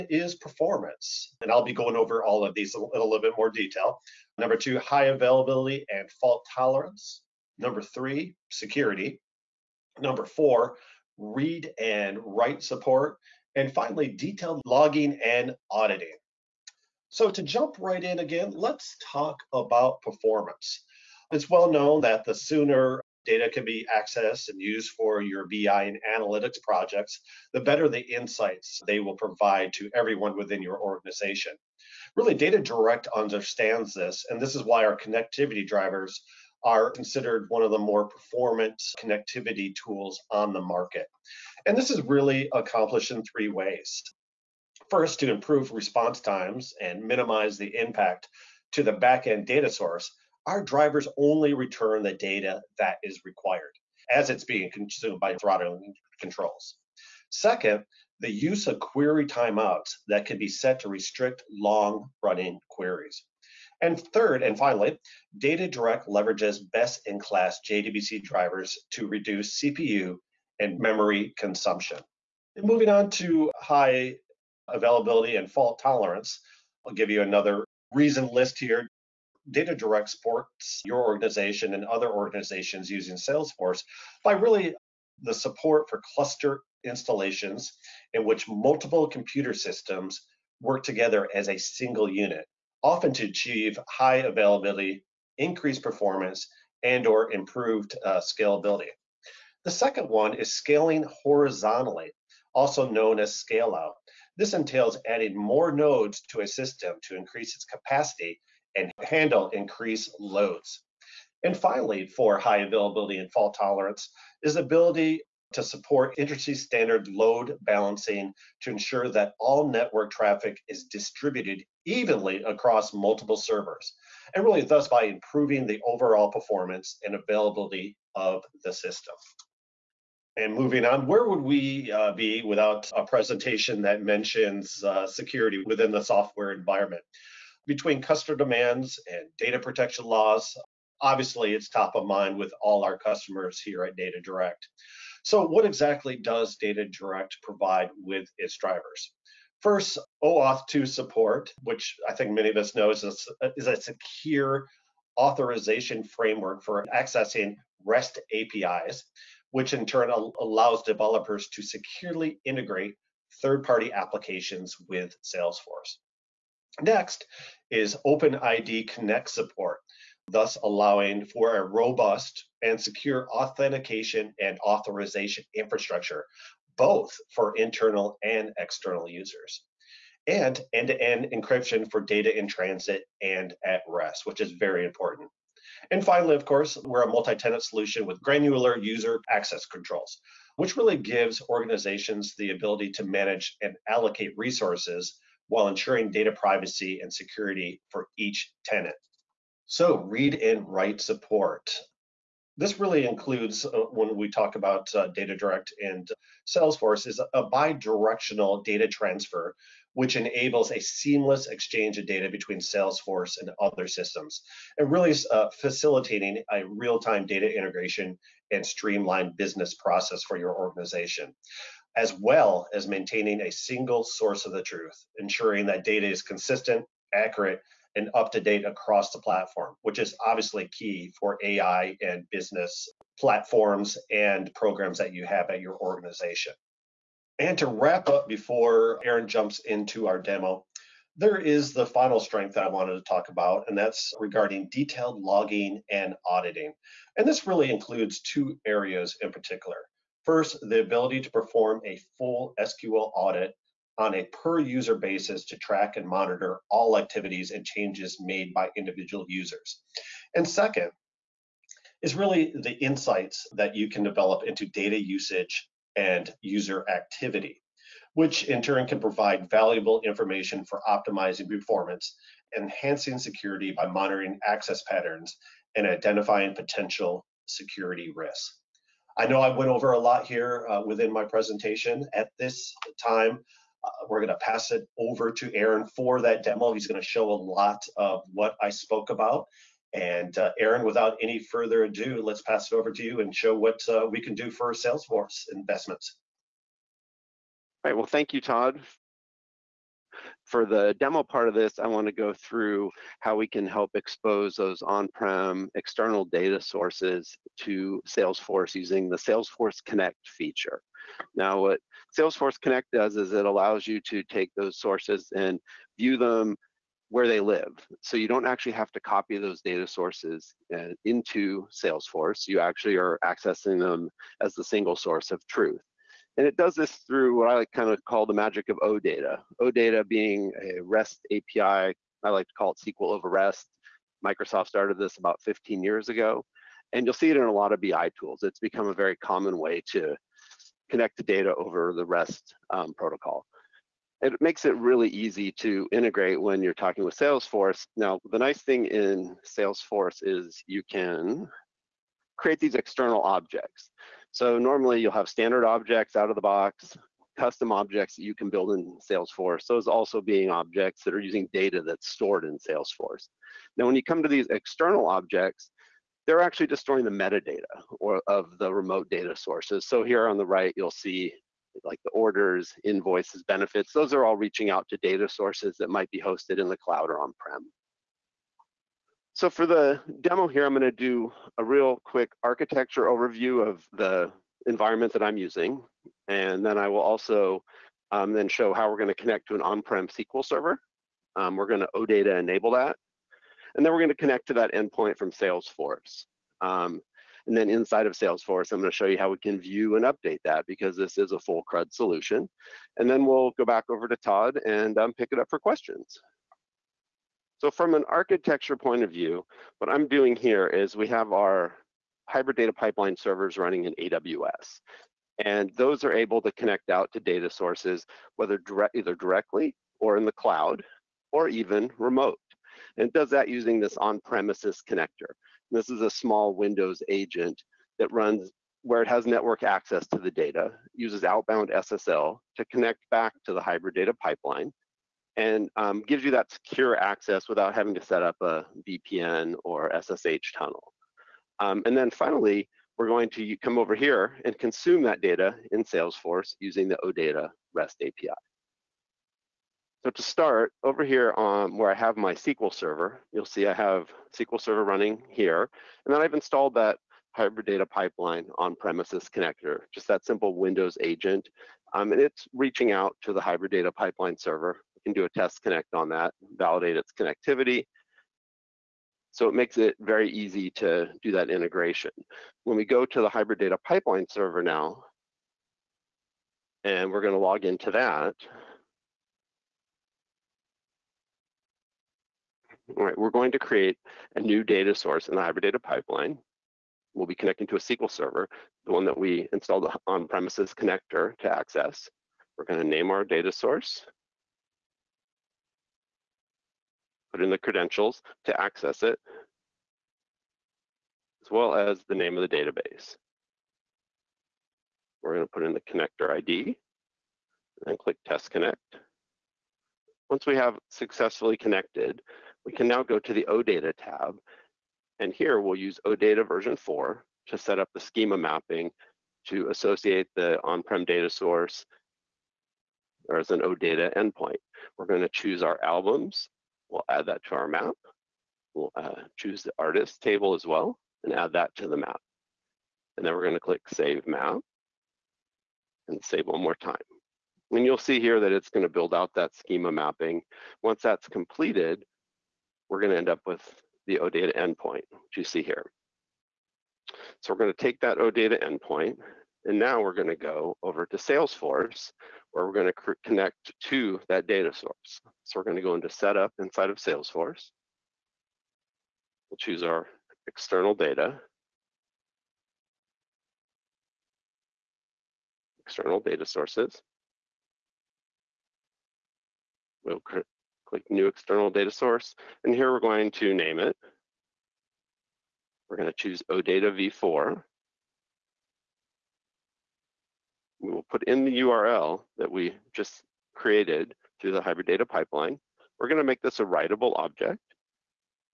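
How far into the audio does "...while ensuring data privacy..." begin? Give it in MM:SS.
03:15.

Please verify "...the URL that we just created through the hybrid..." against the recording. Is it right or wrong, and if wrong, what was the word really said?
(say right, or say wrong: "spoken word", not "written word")
right.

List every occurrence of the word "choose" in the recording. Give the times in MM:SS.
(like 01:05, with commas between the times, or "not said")
08:45, 08:49, 09:19, 09:36.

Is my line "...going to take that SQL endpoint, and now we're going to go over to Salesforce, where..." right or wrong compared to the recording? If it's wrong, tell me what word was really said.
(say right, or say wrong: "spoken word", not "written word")
wrong: "OData", not "SQL".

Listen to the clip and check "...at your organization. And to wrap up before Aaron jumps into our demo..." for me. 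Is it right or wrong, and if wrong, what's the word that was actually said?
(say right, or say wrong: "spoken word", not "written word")
right.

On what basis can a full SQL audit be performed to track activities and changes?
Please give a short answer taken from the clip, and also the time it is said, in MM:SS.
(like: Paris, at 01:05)
Per user basis, at 04:14.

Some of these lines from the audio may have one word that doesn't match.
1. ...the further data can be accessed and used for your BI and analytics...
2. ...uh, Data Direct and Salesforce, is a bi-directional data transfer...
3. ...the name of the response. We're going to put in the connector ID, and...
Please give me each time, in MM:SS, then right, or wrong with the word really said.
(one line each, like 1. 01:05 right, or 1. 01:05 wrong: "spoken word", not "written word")
1. 00:22 wrong: "sooner", not "further"
2. 03:24 right
3. 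08:22 wrong: "database", not "response".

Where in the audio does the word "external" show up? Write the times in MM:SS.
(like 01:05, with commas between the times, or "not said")
02:58, 05:05, 05:52, 06:04, 09:20, 09:25, 09:31.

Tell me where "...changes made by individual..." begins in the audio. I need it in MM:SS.
04:17.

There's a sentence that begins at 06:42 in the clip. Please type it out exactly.
And then we'll go back over to Todd and um, pick it up for questions.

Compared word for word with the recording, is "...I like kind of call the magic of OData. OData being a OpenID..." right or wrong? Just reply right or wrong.
wrong.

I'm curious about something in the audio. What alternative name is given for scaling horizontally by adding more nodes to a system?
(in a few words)
Scale out.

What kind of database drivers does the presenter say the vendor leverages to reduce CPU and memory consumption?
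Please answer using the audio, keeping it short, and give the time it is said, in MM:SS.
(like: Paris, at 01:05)
JDBC drivers, at 01:07.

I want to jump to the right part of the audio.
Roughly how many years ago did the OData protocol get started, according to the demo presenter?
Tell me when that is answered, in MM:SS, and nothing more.
05:35.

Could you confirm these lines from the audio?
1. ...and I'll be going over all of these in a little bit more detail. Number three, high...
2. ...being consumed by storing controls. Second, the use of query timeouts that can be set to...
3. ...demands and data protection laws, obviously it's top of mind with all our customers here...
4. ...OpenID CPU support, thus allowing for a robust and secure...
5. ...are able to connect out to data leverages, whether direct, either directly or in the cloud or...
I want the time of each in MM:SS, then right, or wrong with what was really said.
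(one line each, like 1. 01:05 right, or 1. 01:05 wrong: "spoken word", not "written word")
1. 00:01 wrong: "two", not "three"
2. 00:54 wrong: "throttling", not "storing"
3. 02:18 right
4. 02:48 wrong: "Connect", not "CPU"
5. 06:56 wrong: "sources", not "leverages".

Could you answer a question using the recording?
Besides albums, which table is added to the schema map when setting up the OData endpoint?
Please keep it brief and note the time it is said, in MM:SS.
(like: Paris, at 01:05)
Artist table, at 08:49.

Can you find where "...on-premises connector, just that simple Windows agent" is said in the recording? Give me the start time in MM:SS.
07:38.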